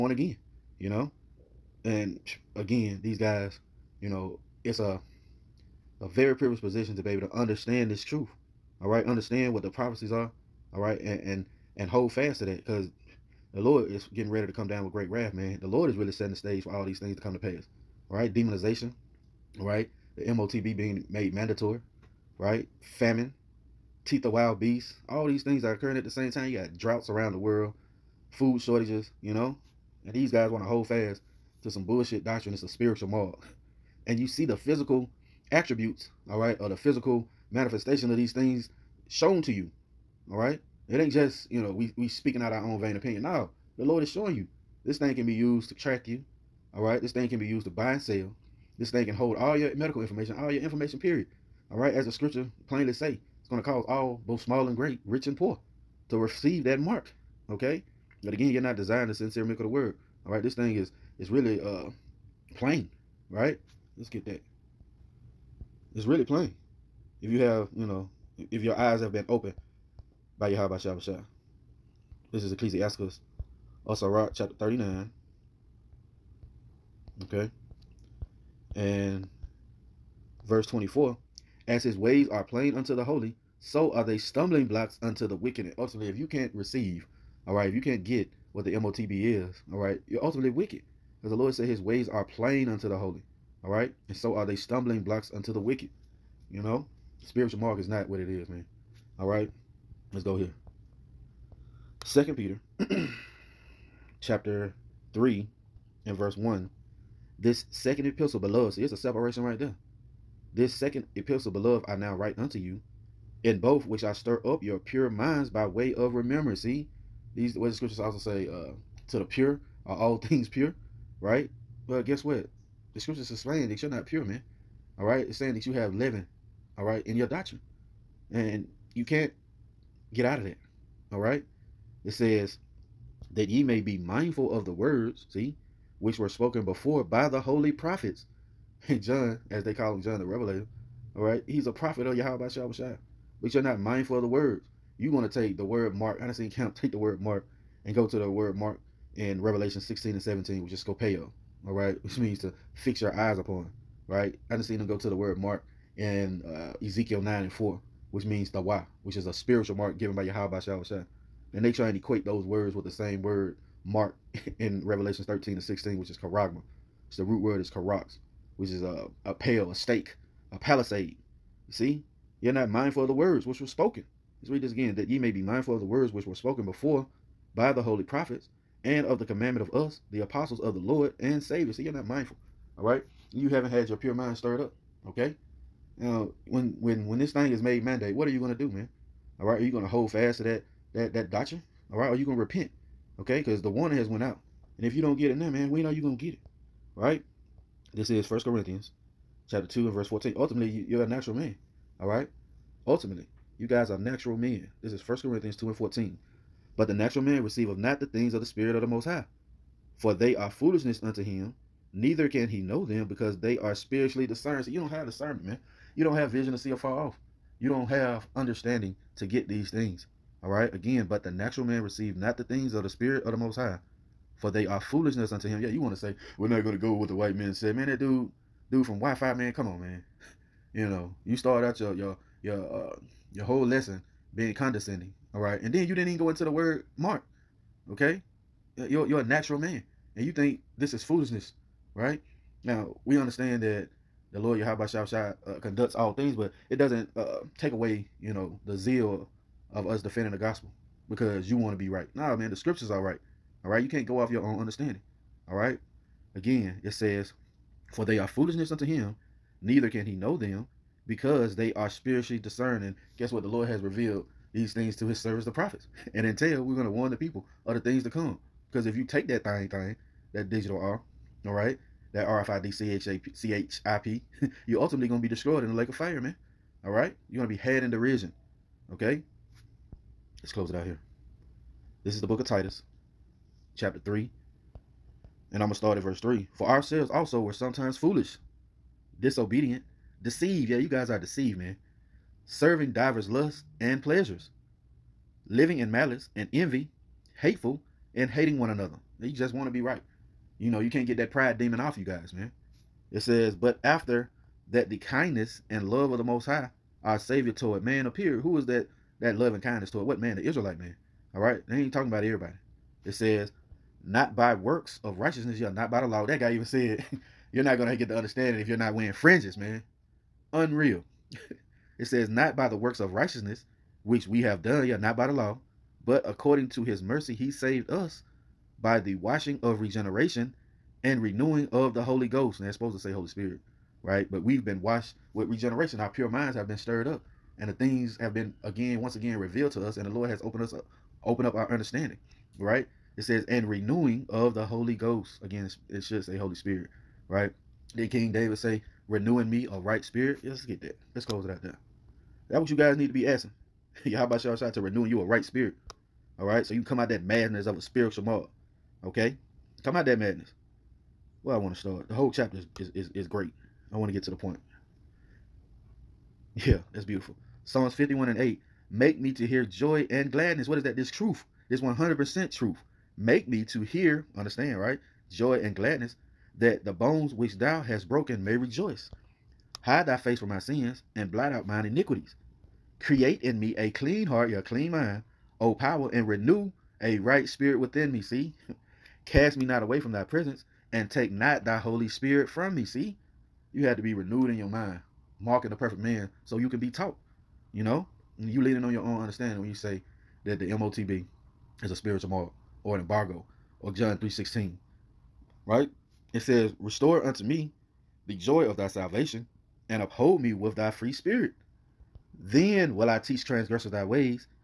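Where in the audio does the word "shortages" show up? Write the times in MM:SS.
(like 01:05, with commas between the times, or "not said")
00:28.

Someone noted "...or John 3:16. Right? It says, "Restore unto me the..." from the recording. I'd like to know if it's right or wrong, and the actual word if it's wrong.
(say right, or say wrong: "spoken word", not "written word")
right.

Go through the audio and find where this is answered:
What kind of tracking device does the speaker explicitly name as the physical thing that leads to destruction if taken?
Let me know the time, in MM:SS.
04:32.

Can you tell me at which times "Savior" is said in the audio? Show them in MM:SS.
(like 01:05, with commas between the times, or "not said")
03:01, 05:07.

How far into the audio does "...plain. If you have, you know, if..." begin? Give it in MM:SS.
01:06.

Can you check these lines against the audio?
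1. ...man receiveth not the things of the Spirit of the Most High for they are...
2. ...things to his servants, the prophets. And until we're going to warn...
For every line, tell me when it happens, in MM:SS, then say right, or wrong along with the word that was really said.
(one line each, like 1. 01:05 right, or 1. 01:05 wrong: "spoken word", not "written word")
1. 03:27 right
2. 04:24 right.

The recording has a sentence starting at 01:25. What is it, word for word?
And ultimately, if you can't receive, all right, if you can't get what the MOTB is, all right, you're ultimately wicked.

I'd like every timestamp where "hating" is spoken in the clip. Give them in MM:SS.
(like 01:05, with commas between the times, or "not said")
04:58.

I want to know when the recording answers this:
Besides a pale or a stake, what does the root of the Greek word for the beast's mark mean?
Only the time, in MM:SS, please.
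02:50.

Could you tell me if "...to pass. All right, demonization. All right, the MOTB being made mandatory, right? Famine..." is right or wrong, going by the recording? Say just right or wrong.
right.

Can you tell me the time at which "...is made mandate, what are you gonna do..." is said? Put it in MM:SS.
03:07.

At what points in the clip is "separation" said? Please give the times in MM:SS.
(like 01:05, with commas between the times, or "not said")
01:48.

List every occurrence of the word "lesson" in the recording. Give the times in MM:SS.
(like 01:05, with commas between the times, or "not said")
03:53.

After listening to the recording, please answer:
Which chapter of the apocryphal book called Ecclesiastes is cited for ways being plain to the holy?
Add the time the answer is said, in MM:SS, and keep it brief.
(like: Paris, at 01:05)
Chapter 39, at 01:14.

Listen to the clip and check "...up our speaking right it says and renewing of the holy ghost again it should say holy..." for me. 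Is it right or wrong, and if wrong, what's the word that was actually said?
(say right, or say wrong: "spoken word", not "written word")
wrong: "understanding", not "speaking".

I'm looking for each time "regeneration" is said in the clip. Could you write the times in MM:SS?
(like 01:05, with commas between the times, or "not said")
05:29, 05:35.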